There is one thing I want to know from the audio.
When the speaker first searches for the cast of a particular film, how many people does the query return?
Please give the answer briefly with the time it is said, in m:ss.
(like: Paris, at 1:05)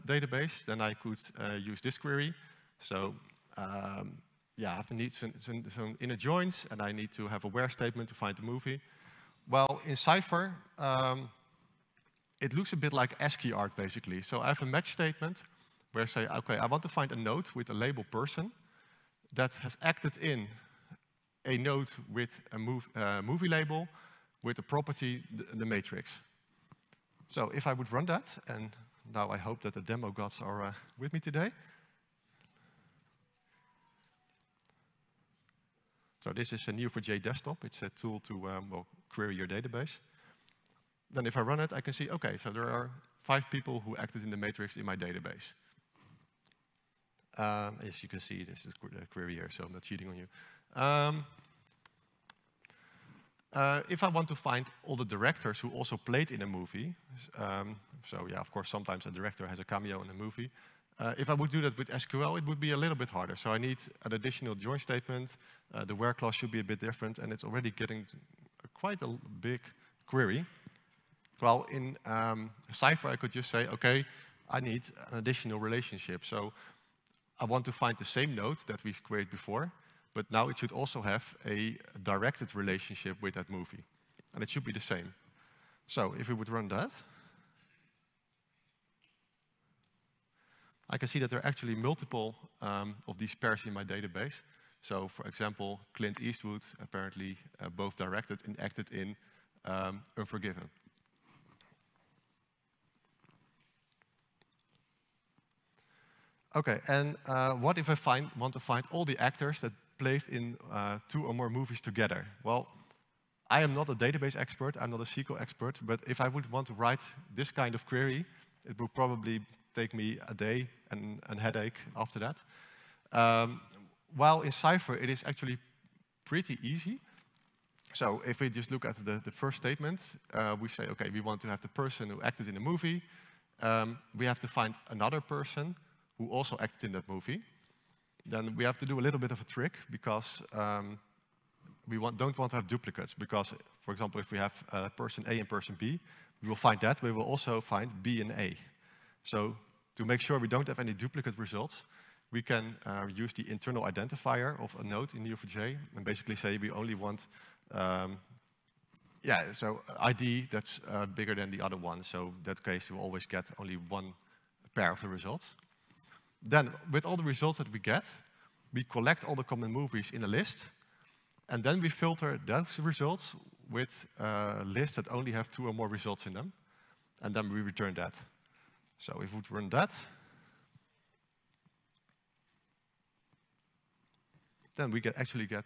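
5, at 0:43.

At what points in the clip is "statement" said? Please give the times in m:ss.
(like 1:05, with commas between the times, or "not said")
0:07, 0:14, 1:04, 2:09.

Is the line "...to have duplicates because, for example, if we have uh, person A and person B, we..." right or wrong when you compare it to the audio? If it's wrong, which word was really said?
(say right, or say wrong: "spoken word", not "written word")
right.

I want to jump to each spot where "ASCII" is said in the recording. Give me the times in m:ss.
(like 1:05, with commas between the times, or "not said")
0:13.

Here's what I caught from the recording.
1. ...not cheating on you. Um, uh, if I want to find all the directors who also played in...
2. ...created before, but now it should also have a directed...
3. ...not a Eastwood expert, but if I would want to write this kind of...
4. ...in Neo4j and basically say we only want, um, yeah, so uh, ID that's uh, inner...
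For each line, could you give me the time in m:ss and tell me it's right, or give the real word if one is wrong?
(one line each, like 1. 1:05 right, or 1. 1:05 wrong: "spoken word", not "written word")
1. 0:49 right
2. 1:19 right
3. 1:54 wrong: "SQL", not "Eastwood"
4. 2:35 wrong: "bigger", not "inner".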